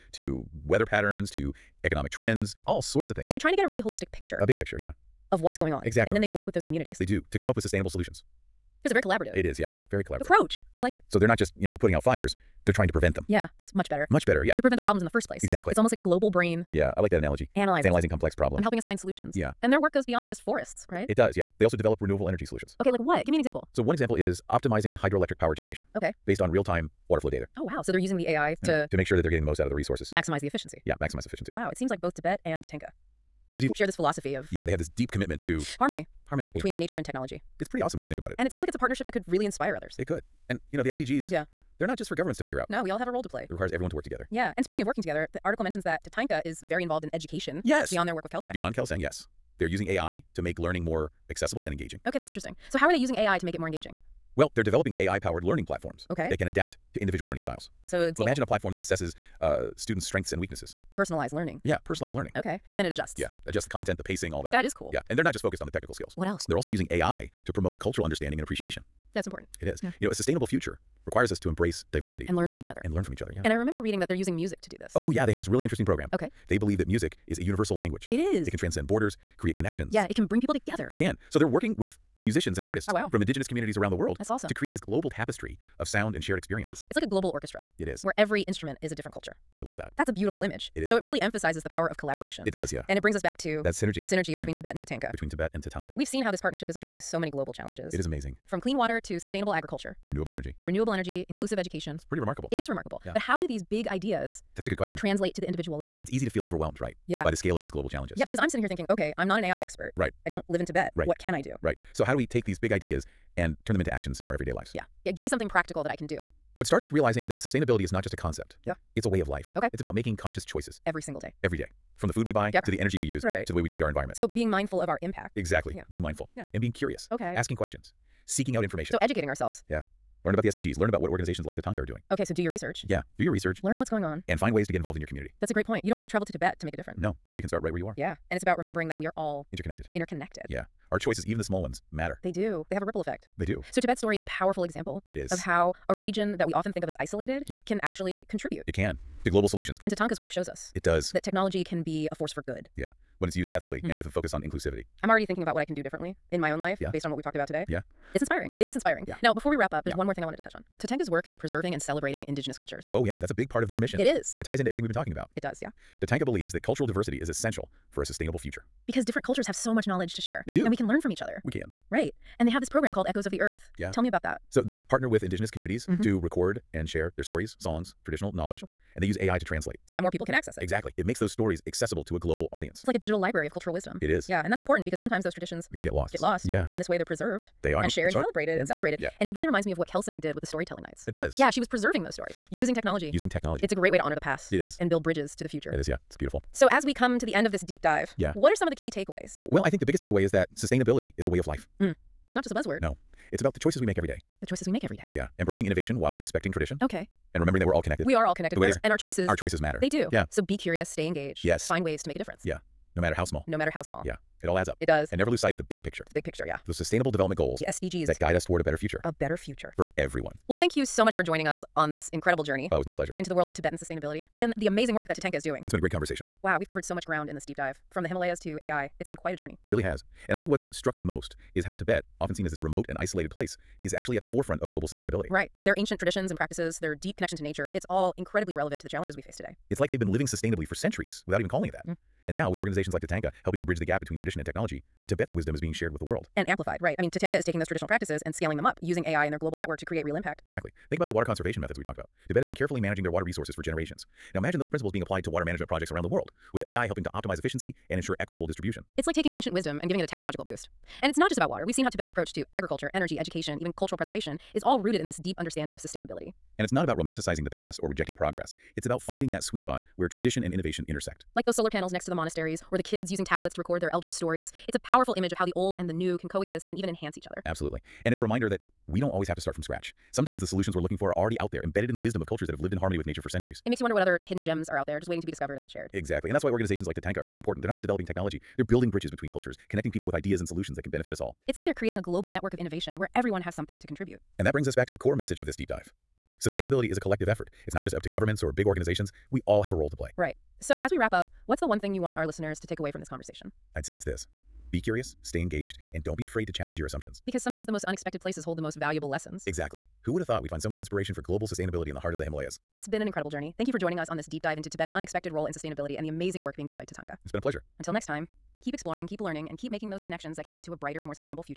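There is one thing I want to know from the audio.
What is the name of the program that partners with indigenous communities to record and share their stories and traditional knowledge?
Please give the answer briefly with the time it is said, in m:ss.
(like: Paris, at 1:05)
Echoes of the Earth, at 2:53.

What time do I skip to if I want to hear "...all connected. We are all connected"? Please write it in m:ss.
3:27.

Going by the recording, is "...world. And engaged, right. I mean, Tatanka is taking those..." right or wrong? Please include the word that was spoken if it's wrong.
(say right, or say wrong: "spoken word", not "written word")
wrong: "amplified", not "engaged".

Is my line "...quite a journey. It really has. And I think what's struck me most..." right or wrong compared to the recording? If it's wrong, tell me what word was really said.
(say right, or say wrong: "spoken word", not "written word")
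right.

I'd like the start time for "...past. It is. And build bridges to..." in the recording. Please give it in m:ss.
3:14.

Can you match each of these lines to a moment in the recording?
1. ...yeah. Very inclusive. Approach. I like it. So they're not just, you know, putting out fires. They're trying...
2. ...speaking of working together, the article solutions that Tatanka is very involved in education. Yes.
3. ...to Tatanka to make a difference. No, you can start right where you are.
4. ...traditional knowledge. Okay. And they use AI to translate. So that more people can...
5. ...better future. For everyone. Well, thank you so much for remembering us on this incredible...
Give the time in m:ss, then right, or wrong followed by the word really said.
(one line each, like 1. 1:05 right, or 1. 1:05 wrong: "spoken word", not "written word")
1. 0:09 wrong: "collaborative", not "inclusive"
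2. 0:44 wrong: "mentions", not "solutions"
3. 2:16 wrong: "Tibet", not "Tatanka"
4. 2:58 right
5. 3:39 wrong: "joining", not "remembering".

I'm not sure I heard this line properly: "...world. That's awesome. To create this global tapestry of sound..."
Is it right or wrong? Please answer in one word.
right.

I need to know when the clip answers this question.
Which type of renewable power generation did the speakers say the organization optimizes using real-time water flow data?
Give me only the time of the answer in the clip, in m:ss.
0:24.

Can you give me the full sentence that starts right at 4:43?
It makes you wonder what other hidden gems are out there, just waiting to be discovered and shared.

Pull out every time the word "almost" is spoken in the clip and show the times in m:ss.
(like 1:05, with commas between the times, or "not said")
0:15.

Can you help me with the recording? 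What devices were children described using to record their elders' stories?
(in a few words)
Tablets.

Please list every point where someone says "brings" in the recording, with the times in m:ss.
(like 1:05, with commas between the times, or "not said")
1:20, 1:33, 4:54.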